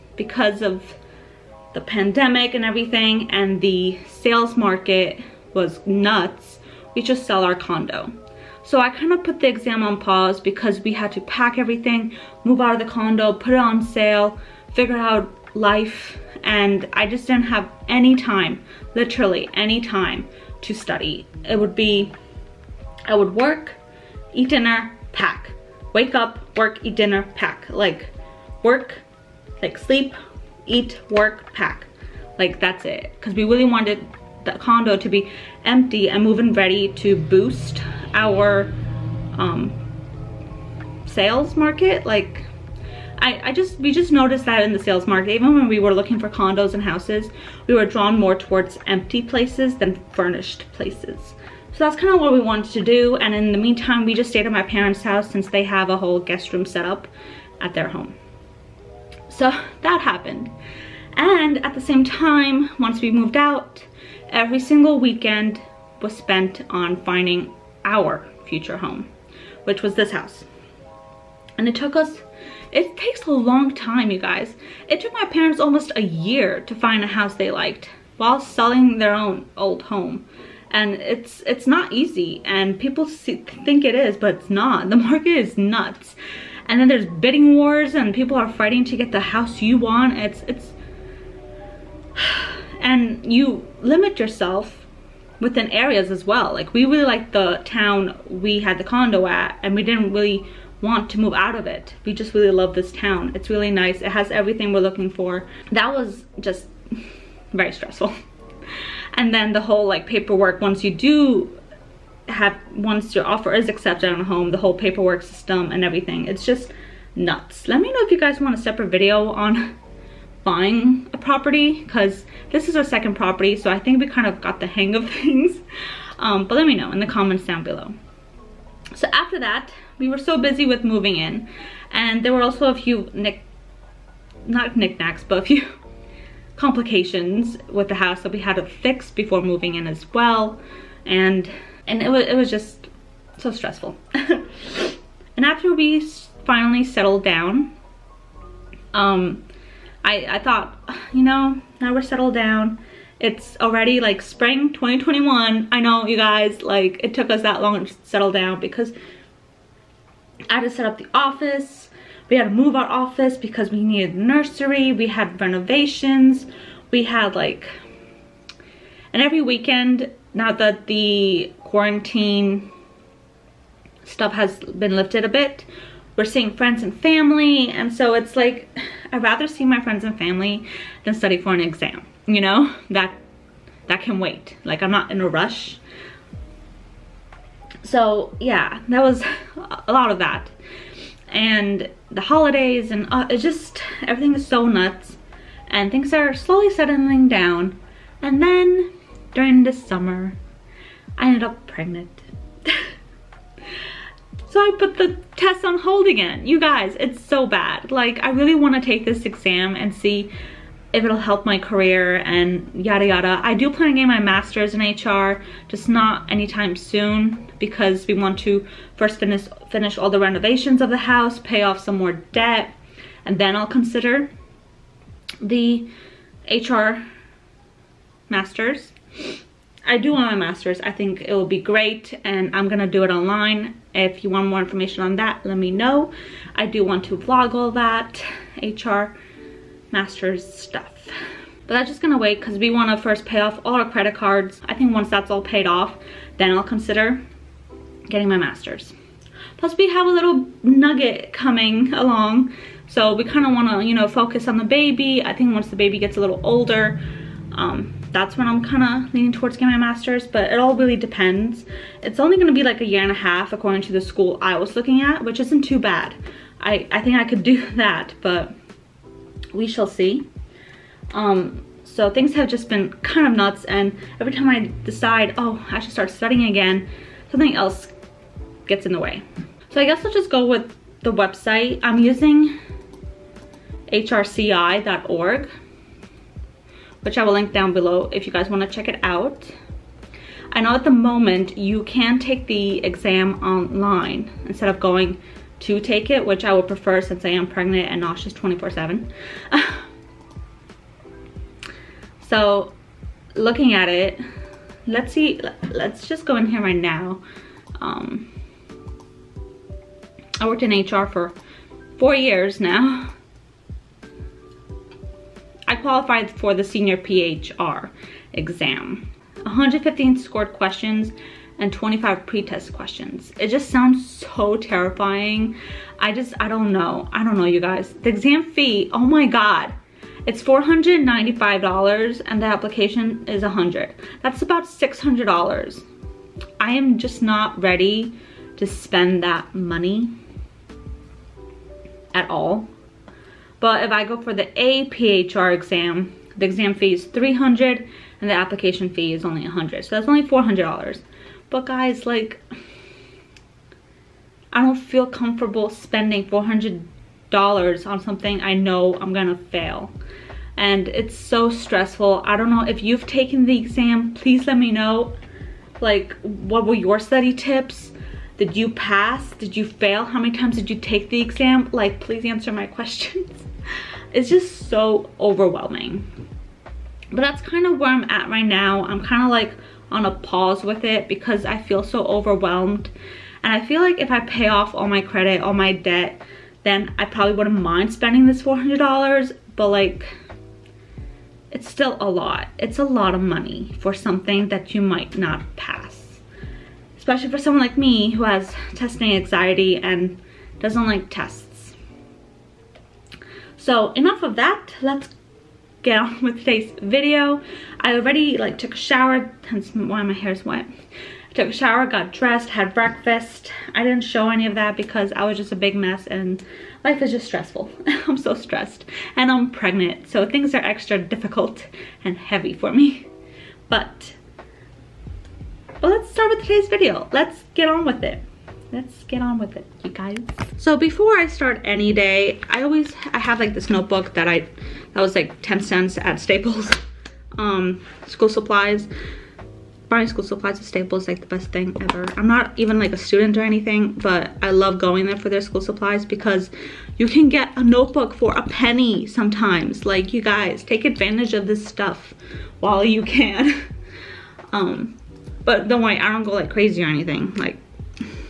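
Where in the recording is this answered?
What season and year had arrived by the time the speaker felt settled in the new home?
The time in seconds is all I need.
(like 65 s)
154 s.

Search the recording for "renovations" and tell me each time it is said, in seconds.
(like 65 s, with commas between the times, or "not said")
165 s, 220 s.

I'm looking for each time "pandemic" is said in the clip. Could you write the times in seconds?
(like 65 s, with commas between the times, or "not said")
1 s.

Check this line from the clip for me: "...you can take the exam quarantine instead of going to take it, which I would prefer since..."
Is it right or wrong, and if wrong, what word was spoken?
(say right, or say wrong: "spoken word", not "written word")
wrong: "online", not "quarantine".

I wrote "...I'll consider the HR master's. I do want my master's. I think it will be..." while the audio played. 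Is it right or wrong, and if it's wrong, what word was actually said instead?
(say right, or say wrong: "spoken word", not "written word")
right.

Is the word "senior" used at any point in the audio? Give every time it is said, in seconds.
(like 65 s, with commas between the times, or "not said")
316 s.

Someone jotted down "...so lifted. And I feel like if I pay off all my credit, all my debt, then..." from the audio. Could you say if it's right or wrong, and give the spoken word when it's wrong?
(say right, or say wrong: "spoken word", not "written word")
wrong: "overwhelmed", not "lifted".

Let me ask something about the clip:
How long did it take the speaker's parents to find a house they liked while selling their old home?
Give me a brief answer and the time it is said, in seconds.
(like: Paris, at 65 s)
Almost a year, at 75 s.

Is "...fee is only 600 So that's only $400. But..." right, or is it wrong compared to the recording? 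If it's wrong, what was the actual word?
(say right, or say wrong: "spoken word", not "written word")
wrong: "100", not "600".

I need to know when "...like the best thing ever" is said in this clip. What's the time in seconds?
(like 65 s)
441 s.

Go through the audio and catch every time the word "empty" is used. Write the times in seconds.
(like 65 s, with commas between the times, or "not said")
35 s, 48 s.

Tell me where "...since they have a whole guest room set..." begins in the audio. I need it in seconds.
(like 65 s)
55 s.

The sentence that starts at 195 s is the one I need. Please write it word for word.
And things are slowly settling down.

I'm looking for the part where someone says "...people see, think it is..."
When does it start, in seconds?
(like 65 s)
82 s.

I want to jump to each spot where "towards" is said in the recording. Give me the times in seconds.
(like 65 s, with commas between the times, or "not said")
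48 s, 259 s.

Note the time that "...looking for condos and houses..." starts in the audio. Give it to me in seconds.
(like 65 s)
45 s.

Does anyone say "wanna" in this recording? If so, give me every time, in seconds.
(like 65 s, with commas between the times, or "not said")
242 s, 288 s.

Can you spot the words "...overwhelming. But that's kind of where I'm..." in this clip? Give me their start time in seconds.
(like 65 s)
375 s.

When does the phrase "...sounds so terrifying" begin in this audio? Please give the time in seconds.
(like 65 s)
323 s.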